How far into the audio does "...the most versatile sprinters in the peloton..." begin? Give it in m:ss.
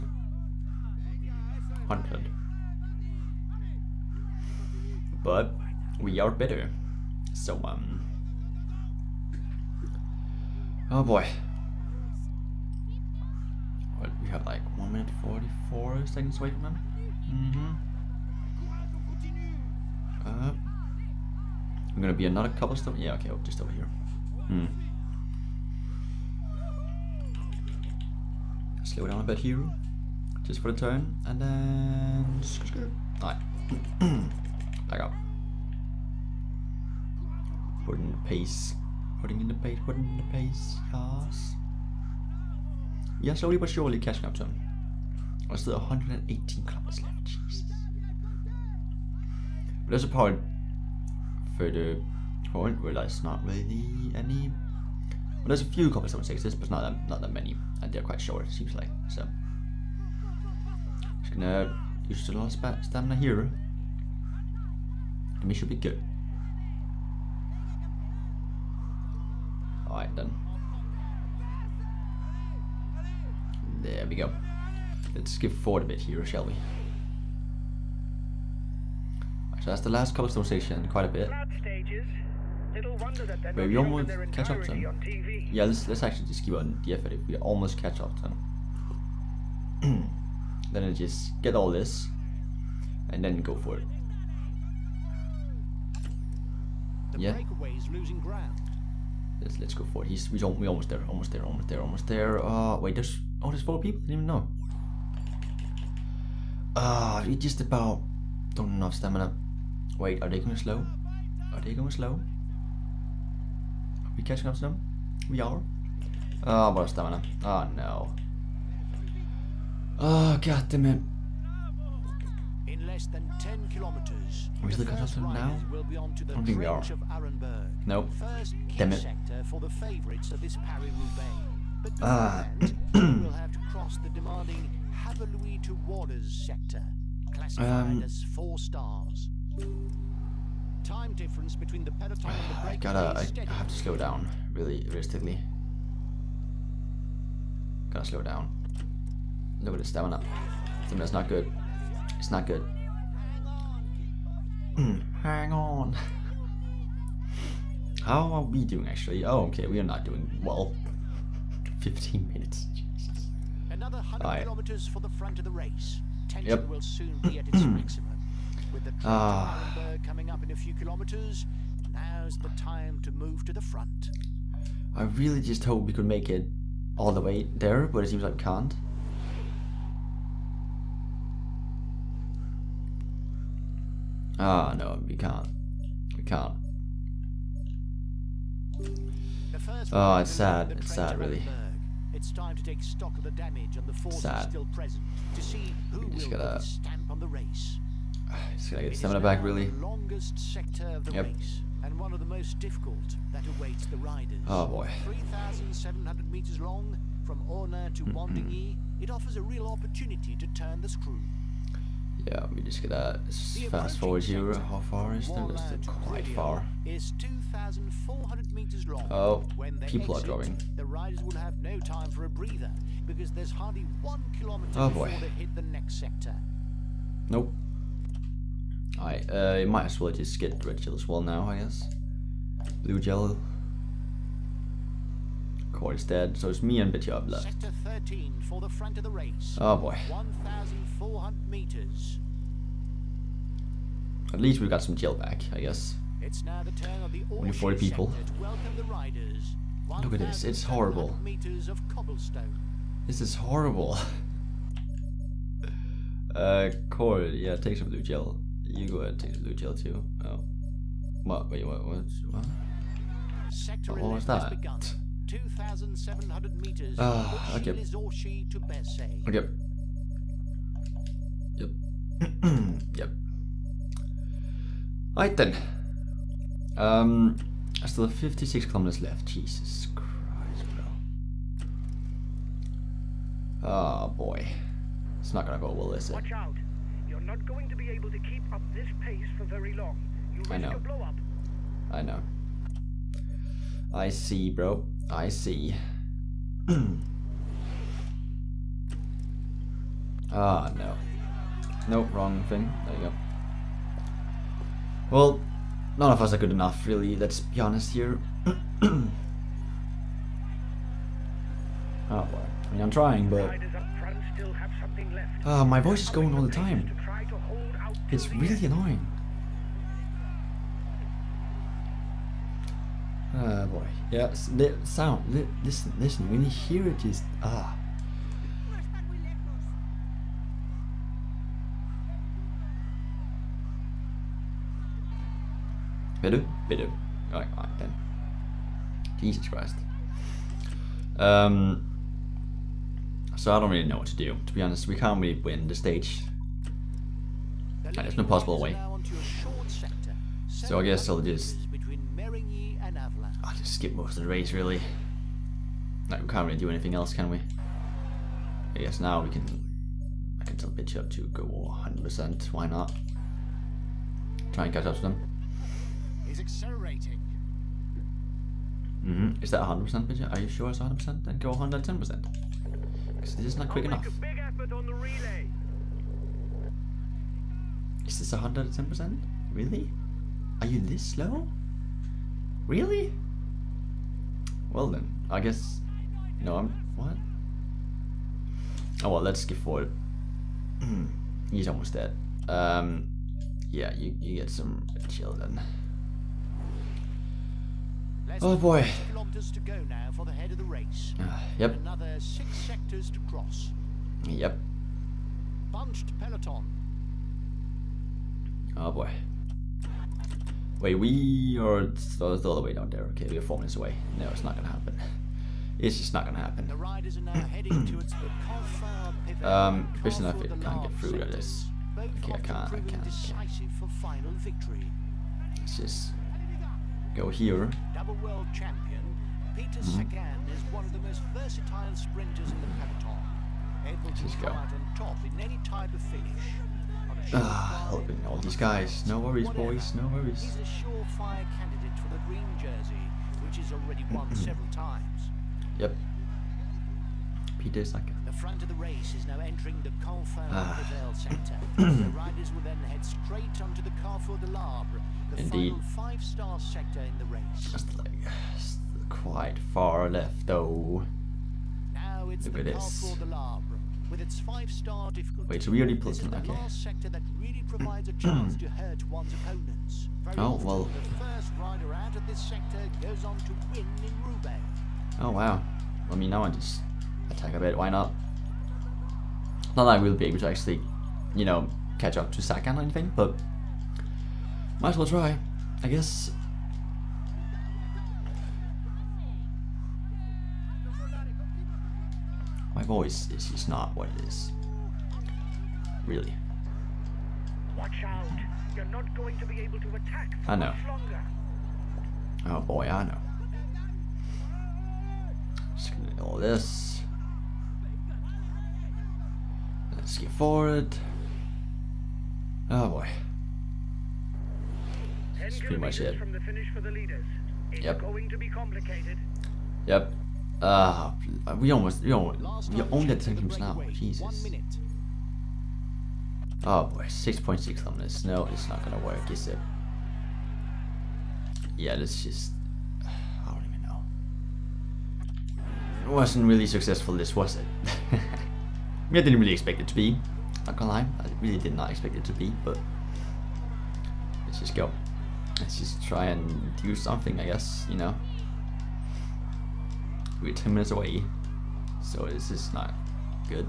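7:10.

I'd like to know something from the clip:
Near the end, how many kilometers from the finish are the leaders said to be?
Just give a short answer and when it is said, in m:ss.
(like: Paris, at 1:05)
6.6, at 8:47.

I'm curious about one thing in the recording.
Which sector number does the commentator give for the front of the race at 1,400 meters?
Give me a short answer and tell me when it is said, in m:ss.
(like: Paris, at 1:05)
13, at 3:57.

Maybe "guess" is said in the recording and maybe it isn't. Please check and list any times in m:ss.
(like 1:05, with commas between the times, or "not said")
3:51, 4:05, 5:50, 5:58, 6:25, 8:05, 9:07.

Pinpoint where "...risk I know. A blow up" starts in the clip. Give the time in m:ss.
4:50.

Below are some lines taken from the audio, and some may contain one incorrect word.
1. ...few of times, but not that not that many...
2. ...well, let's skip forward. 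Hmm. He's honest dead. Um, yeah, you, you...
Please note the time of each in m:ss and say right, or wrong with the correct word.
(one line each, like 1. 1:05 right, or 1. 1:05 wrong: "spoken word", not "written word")
1. 0:55 wrong: "sixes", not "times"
2. 6:29 wrong: "almost", not "honest".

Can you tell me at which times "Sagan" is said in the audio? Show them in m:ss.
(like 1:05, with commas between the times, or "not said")
7:09, 8:02.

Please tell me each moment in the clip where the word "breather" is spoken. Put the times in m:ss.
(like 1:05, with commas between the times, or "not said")
3:42.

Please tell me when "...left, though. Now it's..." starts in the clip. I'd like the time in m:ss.
7:40.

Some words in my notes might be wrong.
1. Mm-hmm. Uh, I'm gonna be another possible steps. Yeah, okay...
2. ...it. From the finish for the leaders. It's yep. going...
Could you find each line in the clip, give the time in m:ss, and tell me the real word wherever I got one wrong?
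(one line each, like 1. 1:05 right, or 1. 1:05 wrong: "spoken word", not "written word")
1. 0:17 wrong: "couple", not "possible"
2. 8:36 right.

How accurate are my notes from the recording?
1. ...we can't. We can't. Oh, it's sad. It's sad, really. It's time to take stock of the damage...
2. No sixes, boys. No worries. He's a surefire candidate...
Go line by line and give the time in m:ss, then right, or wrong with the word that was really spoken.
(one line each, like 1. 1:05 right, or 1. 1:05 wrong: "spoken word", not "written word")
1. 3:05 right
2. 7:19 wrong: "worries", not "sixes".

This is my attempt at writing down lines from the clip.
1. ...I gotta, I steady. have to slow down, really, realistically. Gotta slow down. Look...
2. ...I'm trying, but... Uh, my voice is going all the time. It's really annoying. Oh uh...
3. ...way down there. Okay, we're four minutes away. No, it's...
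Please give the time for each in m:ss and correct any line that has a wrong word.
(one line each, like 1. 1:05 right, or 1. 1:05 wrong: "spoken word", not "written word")
1. 2:22 right
2. 5:12 right
3. 6:52 right.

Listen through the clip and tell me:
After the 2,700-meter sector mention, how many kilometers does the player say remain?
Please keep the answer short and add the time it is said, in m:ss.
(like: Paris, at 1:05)
56, at 4:38.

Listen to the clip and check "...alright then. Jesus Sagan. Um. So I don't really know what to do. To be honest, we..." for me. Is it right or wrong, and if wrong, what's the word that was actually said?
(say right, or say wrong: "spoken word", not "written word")
wrong: "Christ", not "Sagan".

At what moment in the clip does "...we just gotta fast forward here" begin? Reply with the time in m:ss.
3:32.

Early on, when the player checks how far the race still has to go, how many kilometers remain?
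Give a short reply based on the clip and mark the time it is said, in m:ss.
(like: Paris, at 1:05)
118, at 0:45.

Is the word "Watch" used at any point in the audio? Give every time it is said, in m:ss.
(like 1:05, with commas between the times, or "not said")
4:46, 8:17.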